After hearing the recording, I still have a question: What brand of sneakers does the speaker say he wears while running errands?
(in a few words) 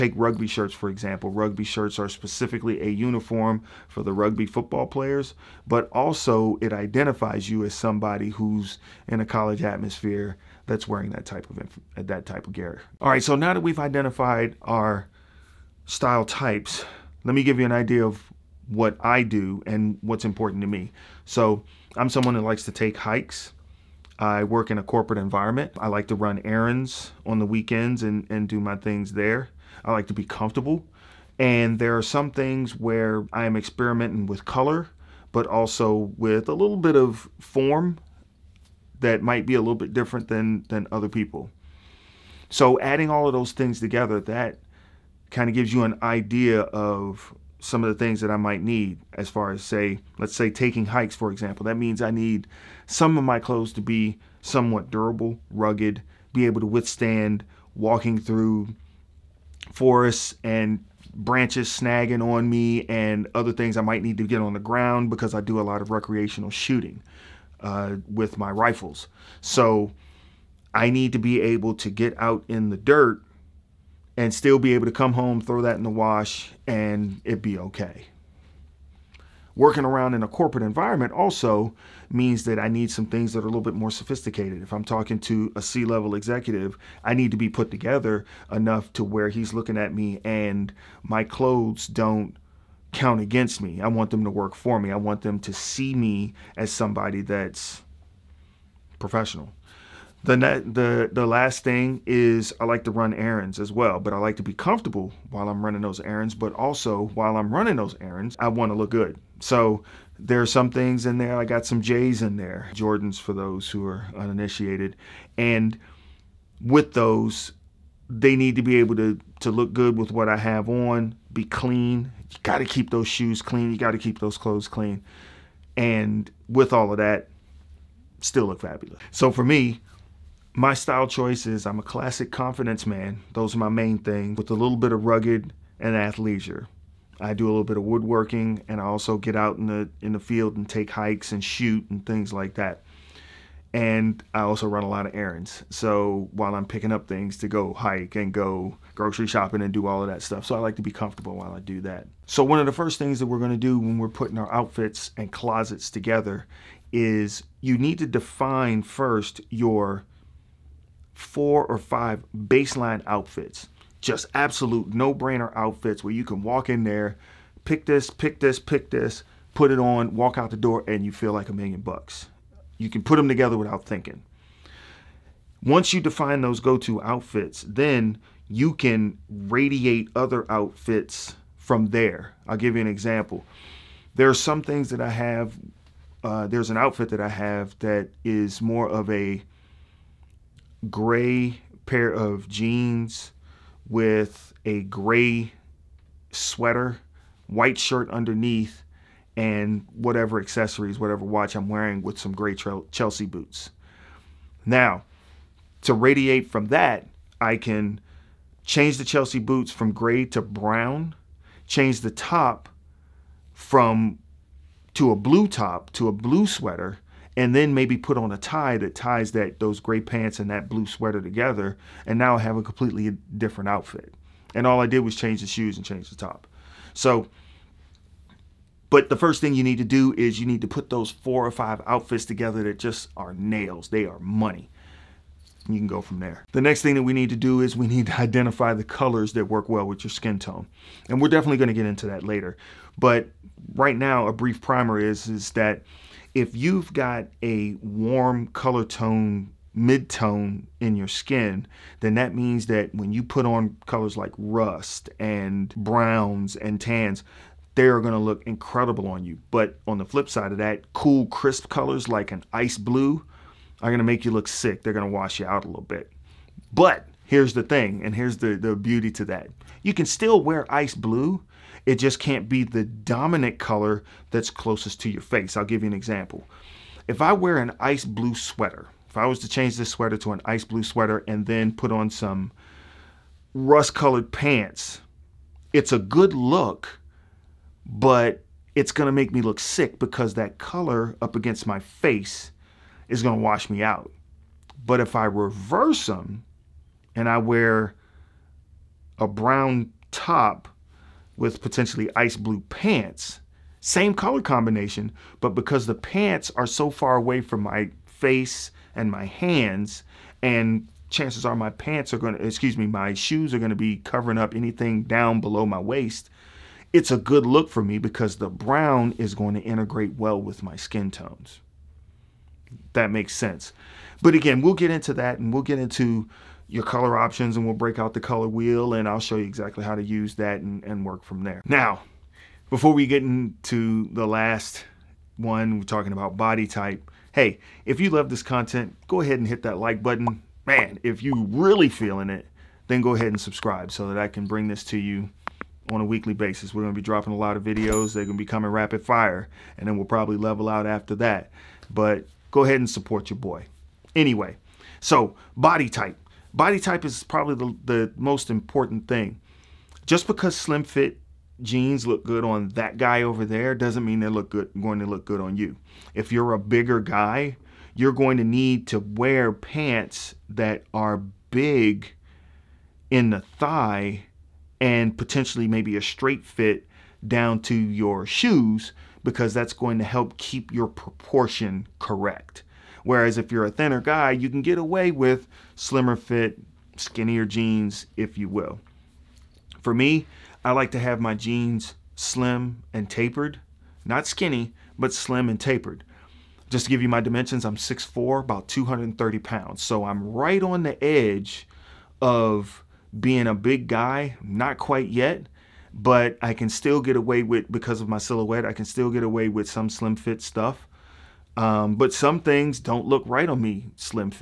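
Jordans.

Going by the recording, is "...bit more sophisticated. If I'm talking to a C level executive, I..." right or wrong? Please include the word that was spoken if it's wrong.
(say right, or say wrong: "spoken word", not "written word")
right.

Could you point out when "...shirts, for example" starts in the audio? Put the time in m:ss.
0:00.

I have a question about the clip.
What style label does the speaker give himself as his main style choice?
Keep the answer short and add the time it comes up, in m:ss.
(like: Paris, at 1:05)
classic confidence man, at 2:11.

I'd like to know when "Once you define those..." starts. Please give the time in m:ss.
2:55.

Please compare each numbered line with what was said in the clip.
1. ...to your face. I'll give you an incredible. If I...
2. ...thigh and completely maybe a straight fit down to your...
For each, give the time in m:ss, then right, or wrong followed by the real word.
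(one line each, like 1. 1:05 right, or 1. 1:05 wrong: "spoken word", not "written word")
1. 4:35 wrong: "example", not "incredible"
2. 6:13 wrong: "potentially", not "completely".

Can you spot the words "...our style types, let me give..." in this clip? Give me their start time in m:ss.
0:14.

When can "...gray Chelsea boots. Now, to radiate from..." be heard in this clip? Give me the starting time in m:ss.
3:22.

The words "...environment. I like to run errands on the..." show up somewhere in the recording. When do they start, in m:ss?
0:25.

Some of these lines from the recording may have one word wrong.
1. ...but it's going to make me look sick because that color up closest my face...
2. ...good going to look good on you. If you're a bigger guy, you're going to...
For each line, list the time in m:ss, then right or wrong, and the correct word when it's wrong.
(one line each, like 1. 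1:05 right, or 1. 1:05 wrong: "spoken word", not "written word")
1. 4:47 wrong: "against", not "closest"
2. 6:04 right.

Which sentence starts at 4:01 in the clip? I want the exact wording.
And we're definitely going to get into that later.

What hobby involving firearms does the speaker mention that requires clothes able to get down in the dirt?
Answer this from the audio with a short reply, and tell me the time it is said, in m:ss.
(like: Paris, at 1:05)
recreational shooting, at 1:05.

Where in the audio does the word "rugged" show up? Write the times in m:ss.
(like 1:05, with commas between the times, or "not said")
0:55, 2:15.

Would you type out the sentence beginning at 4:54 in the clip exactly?
But if I reverse them and I wear a brown top with potentially ice blue pants.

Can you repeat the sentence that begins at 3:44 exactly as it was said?
And all I did was change the shoes and change the top.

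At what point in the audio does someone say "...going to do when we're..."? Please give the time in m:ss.
2:33.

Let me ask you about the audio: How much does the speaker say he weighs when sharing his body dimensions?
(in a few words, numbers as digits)
230 pounds.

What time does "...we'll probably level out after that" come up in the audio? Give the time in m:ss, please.
5:49.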